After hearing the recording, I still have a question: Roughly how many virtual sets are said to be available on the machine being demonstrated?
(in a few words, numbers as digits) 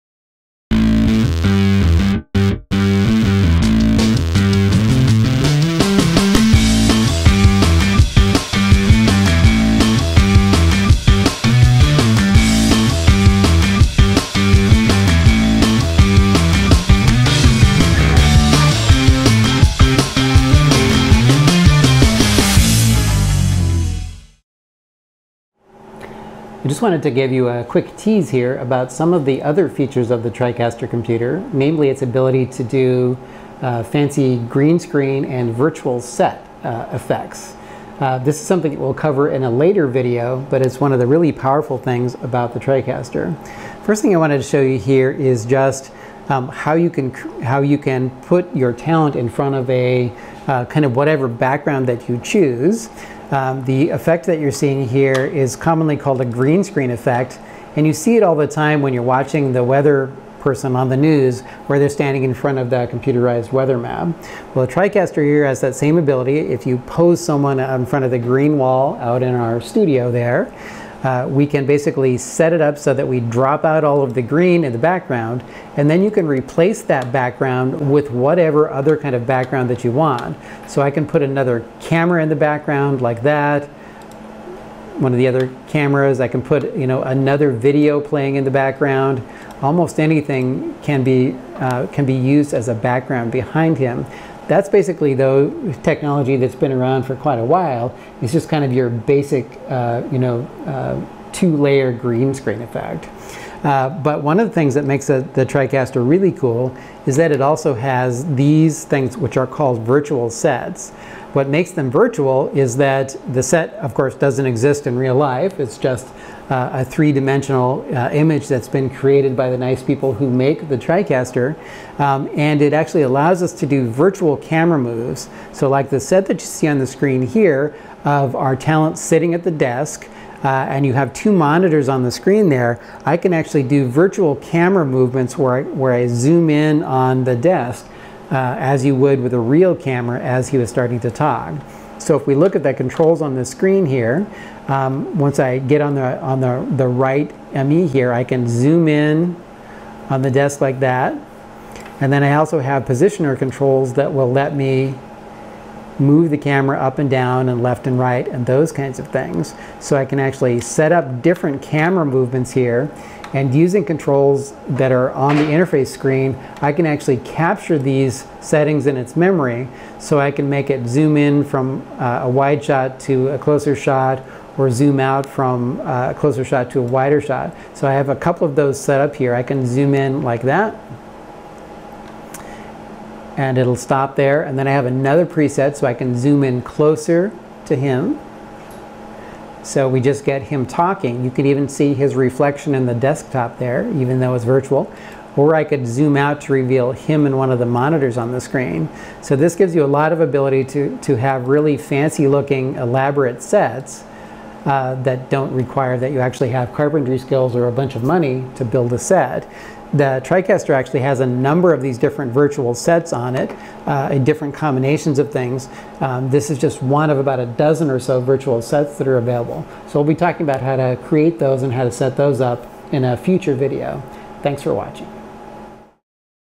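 About a dozen.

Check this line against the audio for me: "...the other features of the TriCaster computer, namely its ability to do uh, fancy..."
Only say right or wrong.
right.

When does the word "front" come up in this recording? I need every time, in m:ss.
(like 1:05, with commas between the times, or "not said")
0:49, 1:02, 1:07.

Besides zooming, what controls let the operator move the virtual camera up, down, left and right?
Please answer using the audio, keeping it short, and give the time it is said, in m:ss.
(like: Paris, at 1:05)
Positioner controls, at 2:32.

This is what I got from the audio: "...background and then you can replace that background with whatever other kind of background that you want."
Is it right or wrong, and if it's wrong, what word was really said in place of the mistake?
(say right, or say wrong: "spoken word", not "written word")
right.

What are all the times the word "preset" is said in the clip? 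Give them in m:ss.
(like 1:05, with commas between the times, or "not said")
3:05.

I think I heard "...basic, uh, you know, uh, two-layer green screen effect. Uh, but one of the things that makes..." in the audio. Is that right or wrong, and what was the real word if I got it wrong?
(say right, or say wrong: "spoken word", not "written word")
right.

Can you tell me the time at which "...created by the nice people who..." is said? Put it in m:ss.
1:58.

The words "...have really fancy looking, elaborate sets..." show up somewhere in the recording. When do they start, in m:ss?
3:21.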